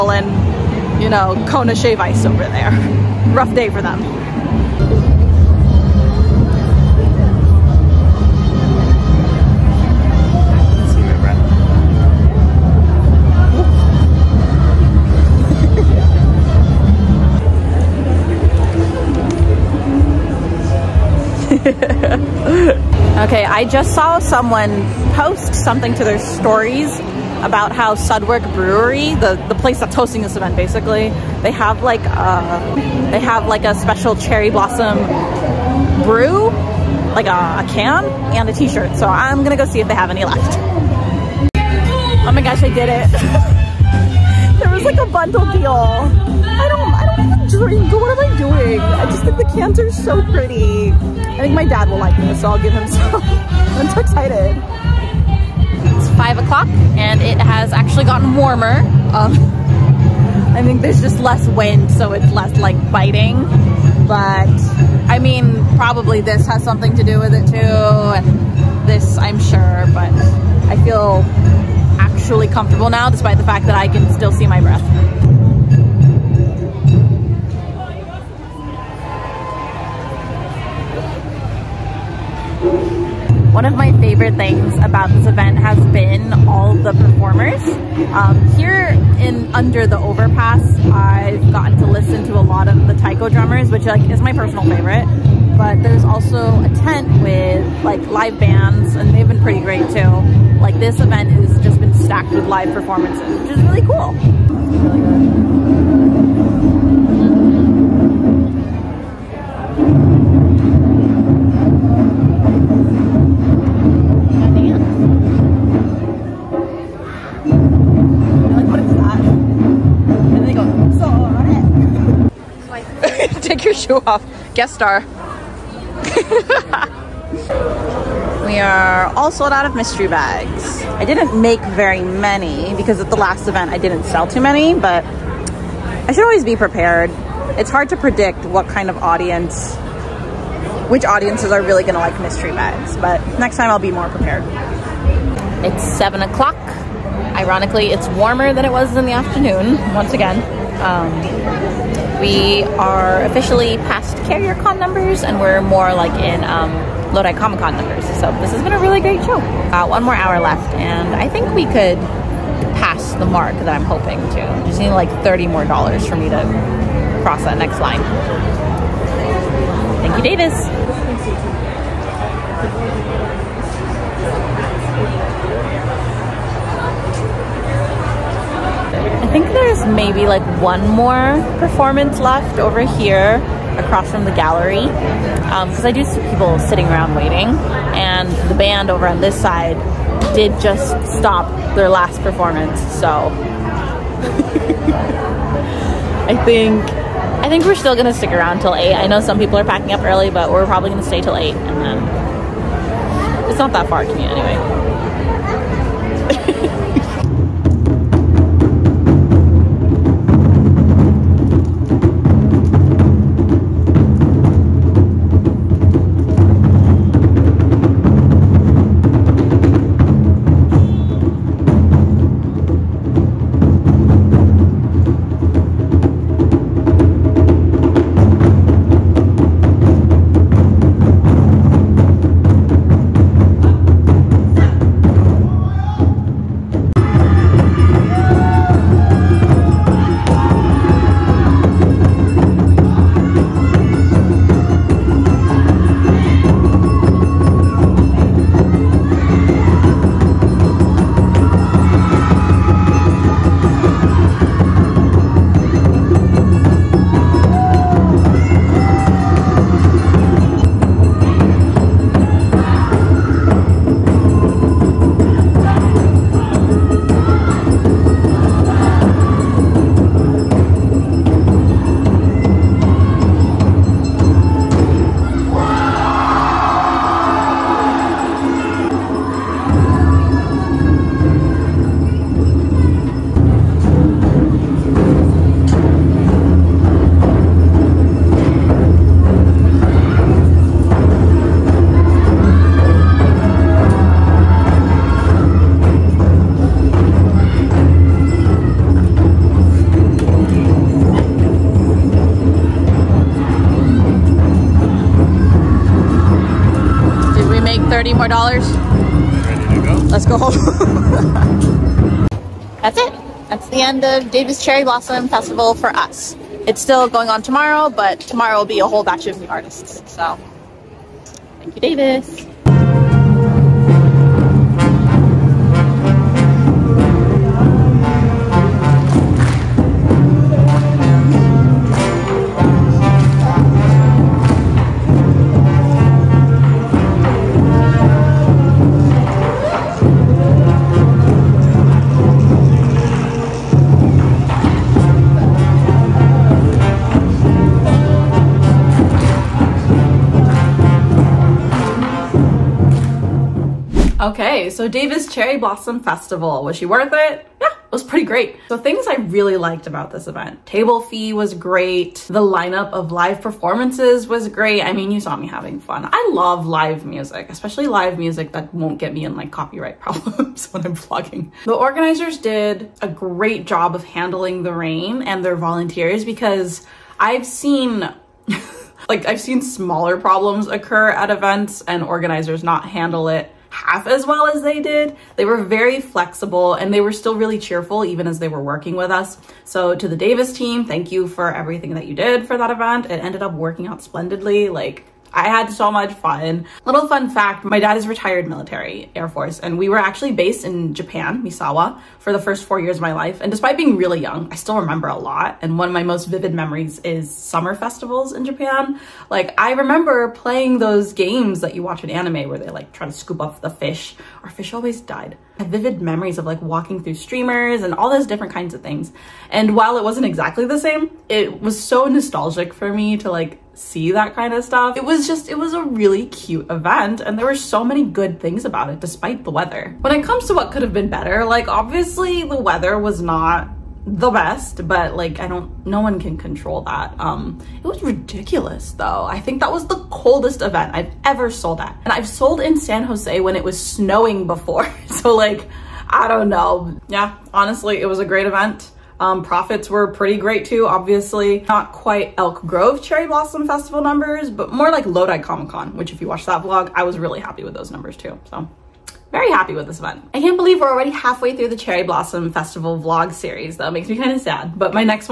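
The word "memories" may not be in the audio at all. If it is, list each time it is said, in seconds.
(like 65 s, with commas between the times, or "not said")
406 s, 415 s.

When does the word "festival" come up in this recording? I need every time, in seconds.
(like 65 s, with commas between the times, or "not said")
315 s, 355 s, 407 s, 453 s, 462 s.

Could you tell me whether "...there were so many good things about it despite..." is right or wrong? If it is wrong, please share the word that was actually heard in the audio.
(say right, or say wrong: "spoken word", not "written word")
right.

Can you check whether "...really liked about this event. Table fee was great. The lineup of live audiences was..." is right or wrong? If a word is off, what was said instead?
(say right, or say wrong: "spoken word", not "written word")
wrong: "performances", not "audiences".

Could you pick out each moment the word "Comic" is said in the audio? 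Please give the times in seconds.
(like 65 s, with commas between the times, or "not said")
157 s, 455 s.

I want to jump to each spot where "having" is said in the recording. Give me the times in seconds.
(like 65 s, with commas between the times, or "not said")
365 s.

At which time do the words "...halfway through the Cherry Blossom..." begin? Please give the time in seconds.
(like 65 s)
461 s.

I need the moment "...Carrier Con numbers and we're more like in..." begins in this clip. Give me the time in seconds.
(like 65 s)
154 s.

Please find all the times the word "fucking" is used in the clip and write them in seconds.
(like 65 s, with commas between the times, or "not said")
not said.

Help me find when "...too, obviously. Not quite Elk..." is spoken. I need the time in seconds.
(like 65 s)
450 s.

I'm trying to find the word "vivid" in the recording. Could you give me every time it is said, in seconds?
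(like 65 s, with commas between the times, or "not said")
406 s, 415 s.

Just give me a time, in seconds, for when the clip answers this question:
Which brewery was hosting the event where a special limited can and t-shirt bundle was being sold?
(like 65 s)
27 s.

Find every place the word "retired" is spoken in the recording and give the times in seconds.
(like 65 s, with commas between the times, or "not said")
398 s.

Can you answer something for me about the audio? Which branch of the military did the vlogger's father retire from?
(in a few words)
Air Force.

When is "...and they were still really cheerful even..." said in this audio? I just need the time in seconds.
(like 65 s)
386 s.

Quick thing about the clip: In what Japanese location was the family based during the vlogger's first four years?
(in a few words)
Misawa.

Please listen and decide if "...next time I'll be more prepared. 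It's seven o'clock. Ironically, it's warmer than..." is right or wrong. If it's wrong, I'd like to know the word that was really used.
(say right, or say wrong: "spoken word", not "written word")
right.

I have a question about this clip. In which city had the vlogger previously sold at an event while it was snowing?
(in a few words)
San Jose.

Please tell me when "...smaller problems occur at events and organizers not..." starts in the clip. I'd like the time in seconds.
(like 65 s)
379 s.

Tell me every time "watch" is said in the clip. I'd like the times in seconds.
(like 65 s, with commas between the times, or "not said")
411 s, 456 s.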